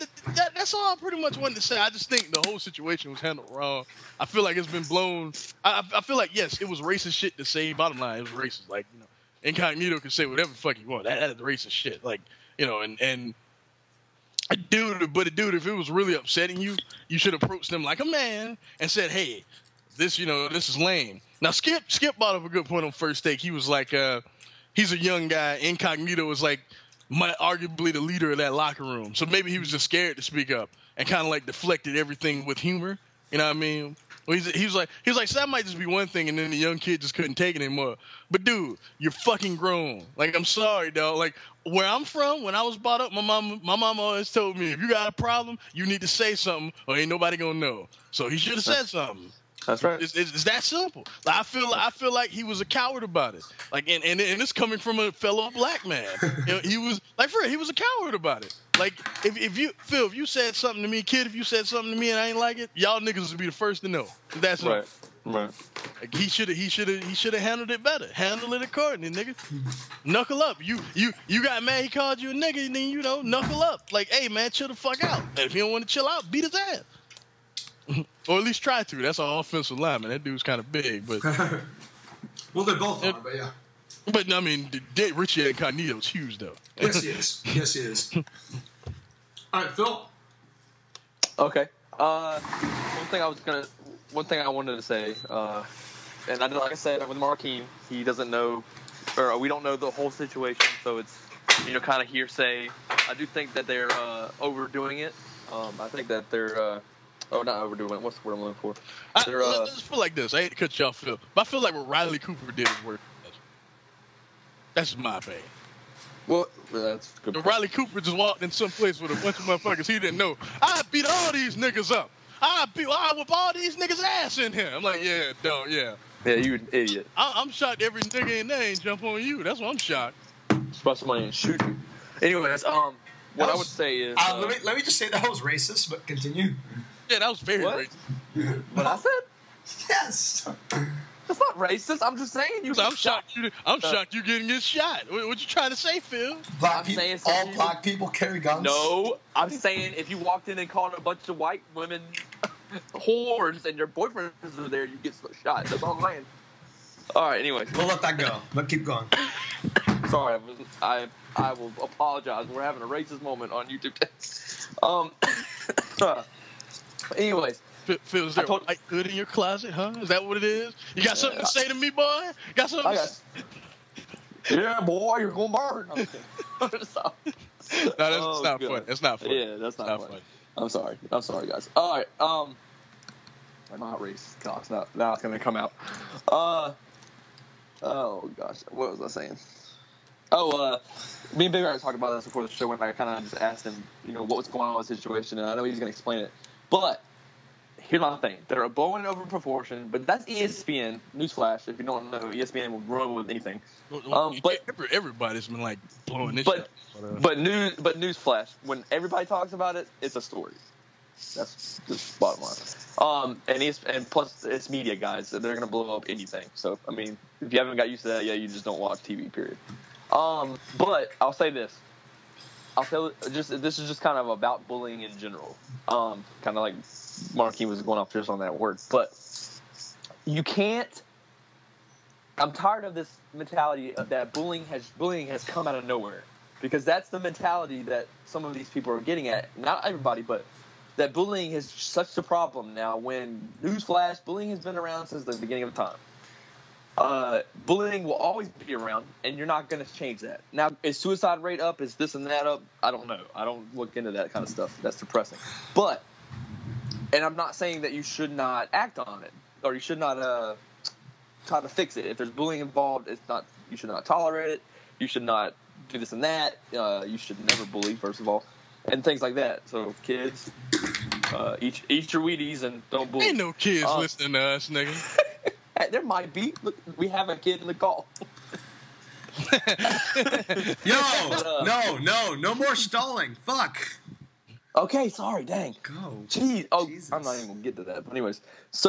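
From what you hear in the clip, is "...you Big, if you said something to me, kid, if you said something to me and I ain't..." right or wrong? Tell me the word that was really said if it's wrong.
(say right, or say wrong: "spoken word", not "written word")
wrong: "Phil", not "Big".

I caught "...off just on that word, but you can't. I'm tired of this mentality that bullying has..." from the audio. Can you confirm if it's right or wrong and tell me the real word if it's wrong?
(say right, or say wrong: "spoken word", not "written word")
right.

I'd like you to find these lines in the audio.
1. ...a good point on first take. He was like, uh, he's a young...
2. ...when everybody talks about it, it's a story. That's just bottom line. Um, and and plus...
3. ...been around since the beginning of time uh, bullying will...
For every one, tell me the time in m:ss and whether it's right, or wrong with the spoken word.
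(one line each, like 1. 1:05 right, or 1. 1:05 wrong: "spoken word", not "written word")
1. 0:22 right
2. 3:28 right
3. 4:04 right.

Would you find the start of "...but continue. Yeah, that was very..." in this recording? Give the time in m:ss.
2:15.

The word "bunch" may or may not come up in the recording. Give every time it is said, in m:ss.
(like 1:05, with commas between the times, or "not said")
1:59, 2:31.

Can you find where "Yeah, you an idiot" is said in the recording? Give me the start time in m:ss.
2:06.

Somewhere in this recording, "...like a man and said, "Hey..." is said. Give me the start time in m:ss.
0:17.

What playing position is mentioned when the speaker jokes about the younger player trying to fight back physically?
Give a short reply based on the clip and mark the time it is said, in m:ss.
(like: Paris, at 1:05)
Offensive lineman, at 1:19.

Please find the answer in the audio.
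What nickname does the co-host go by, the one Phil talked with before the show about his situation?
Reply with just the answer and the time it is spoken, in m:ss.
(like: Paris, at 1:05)
Big Red, at 3:11.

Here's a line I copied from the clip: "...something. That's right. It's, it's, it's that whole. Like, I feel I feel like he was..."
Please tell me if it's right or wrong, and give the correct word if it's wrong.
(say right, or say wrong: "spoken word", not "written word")
wrong: "simple", not "whole".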